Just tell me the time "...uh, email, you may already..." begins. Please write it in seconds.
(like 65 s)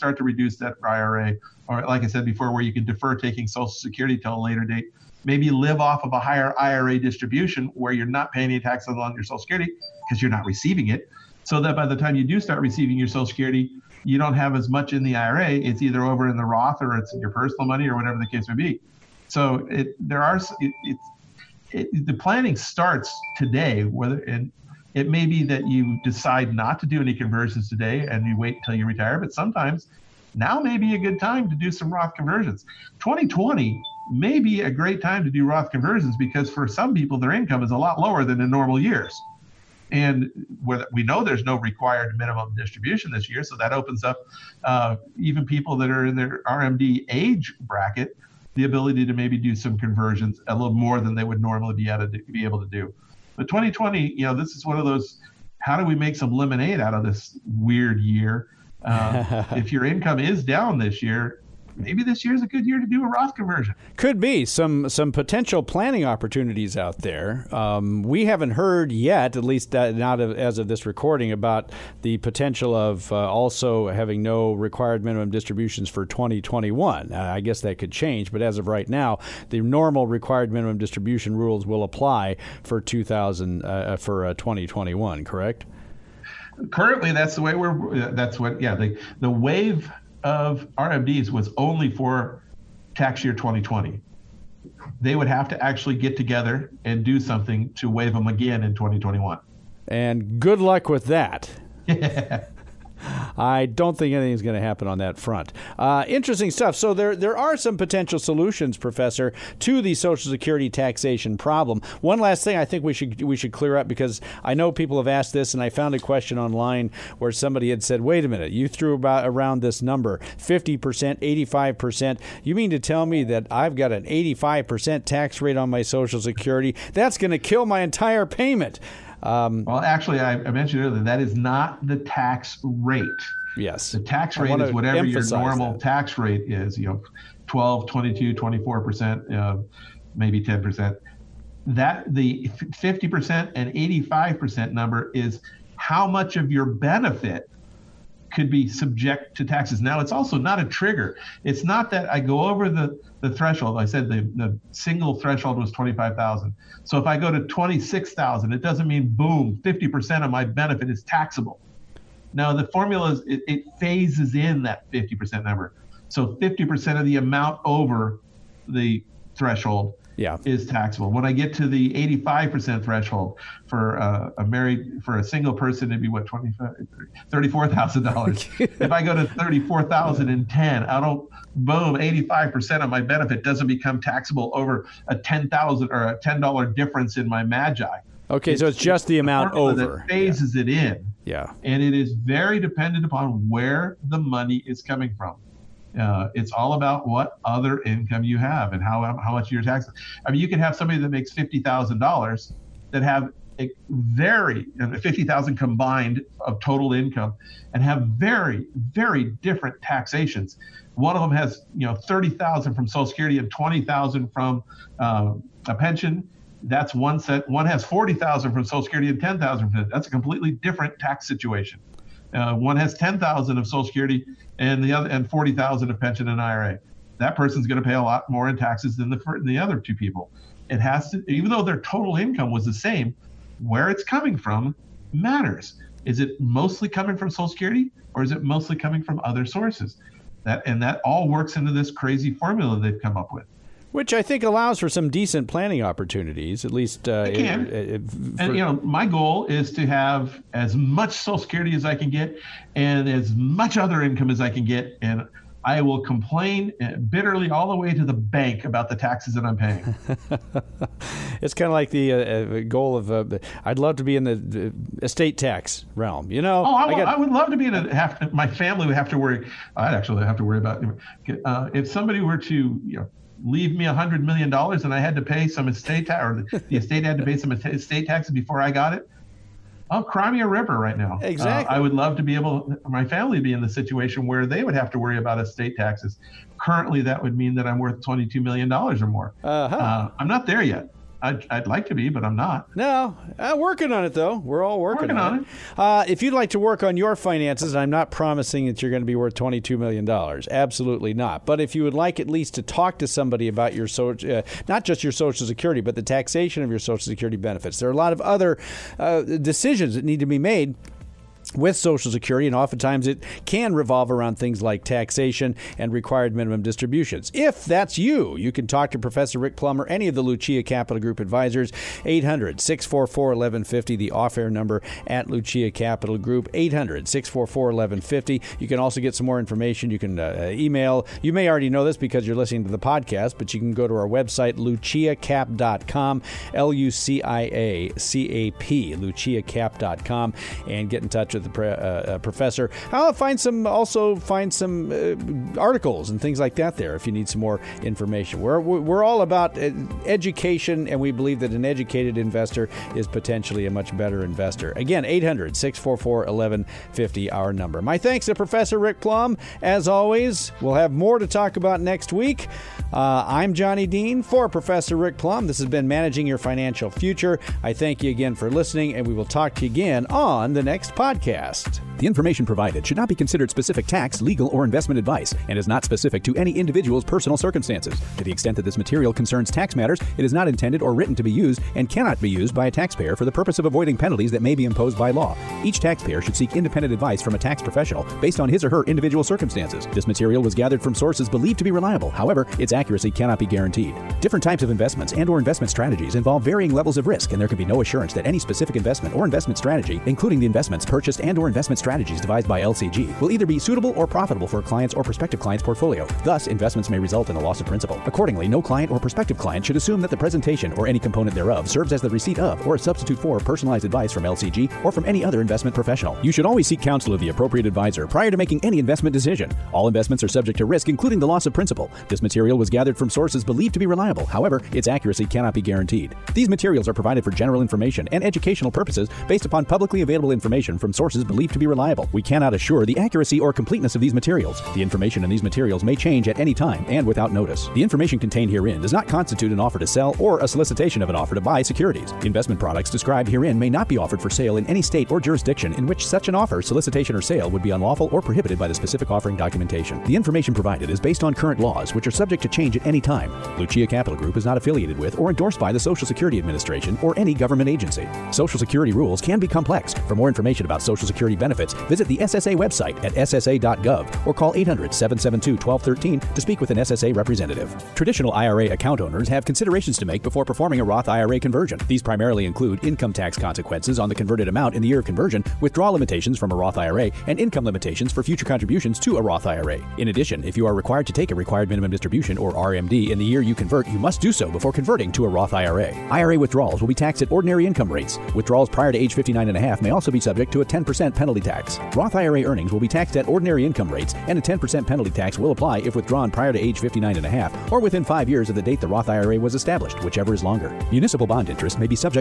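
330 s.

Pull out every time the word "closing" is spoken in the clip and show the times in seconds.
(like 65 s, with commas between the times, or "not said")
not said.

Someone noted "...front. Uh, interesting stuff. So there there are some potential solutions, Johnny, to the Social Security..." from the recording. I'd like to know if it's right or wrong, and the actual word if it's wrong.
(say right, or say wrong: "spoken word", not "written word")
wrong: "Professor", not "Johnny".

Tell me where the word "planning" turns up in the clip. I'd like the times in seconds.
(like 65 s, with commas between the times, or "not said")
22 s, 65 s, 245 s.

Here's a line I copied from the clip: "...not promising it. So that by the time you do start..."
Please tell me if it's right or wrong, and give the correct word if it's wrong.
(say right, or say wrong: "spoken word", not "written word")
wrong: "receiving", not "promising".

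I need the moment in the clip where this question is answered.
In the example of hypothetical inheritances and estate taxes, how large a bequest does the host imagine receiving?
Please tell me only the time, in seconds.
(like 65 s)
273 s.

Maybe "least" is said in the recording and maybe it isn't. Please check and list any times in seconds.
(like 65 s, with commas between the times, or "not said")
69 s, 246 s, 302 s.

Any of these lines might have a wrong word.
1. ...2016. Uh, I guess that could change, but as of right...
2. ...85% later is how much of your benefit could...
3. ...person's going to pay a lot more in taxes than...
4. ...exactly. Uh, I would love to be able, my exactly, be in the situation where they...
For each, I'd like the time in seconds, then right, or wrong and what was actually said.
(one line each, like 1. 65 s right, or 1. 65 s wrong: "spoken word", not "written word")
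1. 76 s wrong: "2021", not "2016"
2. 143 s wrong: "number", not "later"
3. 227 s right
4. 281 s wrong: "family", not "exactly".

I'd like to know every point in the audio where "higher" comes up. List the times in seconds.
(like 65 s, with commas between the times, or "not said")
6 s.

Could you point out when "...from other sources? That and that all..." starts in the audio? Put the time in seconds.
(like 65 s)
239 s.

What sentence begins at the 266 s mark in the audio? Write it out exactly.
You know, oh, I, I would love to be in a have to, my family would have to worry.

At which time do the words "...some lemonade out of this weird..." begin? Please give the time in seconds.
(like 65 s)
56 s.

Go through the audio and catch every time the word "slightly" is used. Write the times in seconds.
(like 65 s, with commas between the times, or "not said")
not said.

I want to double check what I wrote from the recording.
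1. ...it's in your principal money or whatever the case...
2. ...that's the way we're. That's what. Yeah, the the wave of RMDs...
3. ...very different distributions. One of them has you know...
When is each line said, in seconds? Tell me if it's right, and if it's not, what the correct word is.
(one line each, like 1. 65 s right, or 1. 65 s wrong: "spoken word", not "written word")
1. 16 s wrong: "personal", not "principal"
2. 87 s right
3. 208 s wrong: "taxations", not "distributions".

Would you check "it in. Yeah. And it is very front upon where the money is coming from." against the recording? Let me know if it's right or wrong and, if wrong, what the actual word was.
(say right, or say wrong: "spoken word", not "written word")
wrong: "dependent", not "front".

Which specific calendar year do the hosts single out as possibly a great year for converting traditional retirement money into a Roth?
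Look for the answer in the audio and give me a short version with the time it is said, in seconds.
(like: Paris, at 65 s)
2020, at 32 s.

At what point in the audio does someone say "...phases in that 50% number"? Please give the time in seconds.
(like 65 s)
163 s.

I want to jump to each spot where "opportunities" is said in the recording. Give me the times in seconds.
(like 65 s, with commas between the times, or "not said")
66 s, 245 s.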